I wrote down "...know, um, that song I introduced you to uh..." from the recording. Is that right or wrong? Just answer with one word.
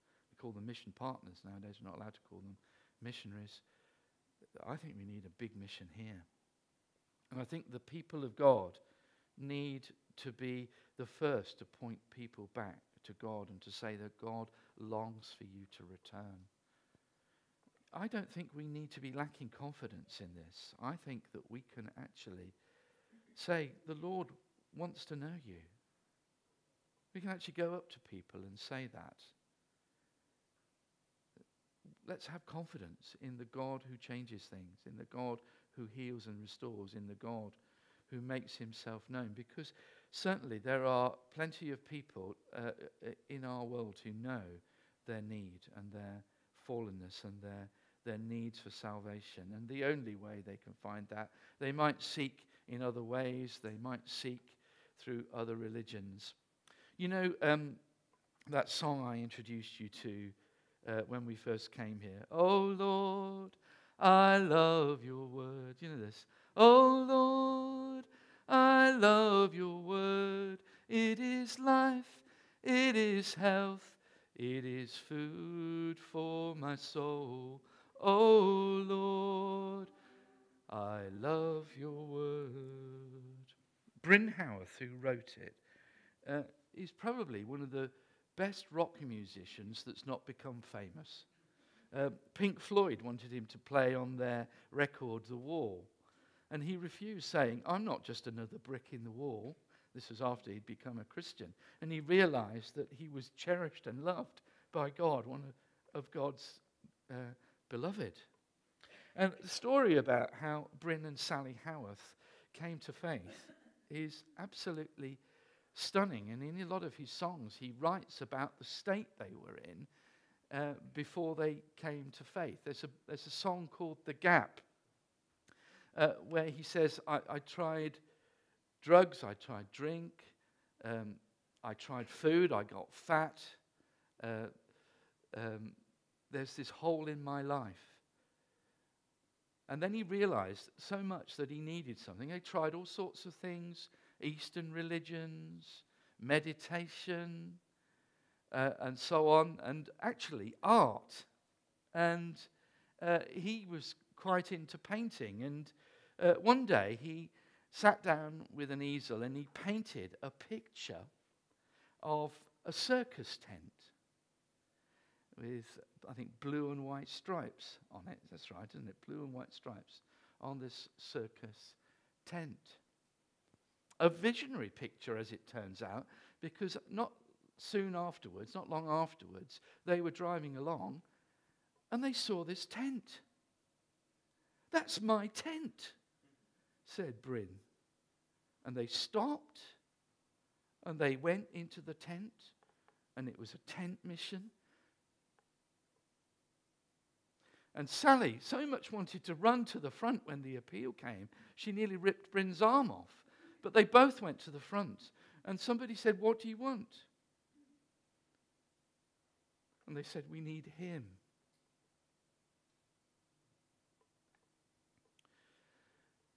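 right.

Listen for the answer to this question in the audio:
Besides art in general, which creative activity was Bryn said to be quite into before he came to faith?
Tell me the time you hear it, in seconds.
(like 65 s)
154 s.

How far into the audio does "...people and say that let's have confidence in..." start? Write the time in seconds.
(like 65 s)
28 s.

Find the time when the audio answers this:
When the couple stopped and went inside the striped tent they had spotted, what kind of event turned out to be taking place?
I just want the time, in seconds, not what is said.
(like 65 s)
193 s.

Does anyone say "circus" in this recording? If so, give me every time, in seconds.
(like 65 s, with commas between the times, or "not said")
162 s, 170 s.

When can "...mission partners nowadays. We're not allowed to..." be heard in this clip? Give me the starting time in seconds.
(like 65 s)
0 s.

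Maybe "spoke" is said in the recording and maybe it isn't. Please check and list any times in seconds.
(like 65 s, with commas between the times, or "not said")
not said.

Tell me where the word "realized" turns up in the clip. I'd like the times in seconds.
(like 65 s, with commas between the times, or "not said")
102 s, 140 s.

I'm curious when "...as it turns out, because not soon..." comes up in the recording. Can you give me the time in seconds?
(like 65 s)
175 s.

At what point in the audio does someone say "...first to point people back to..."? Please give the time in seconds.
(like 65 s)
11 s.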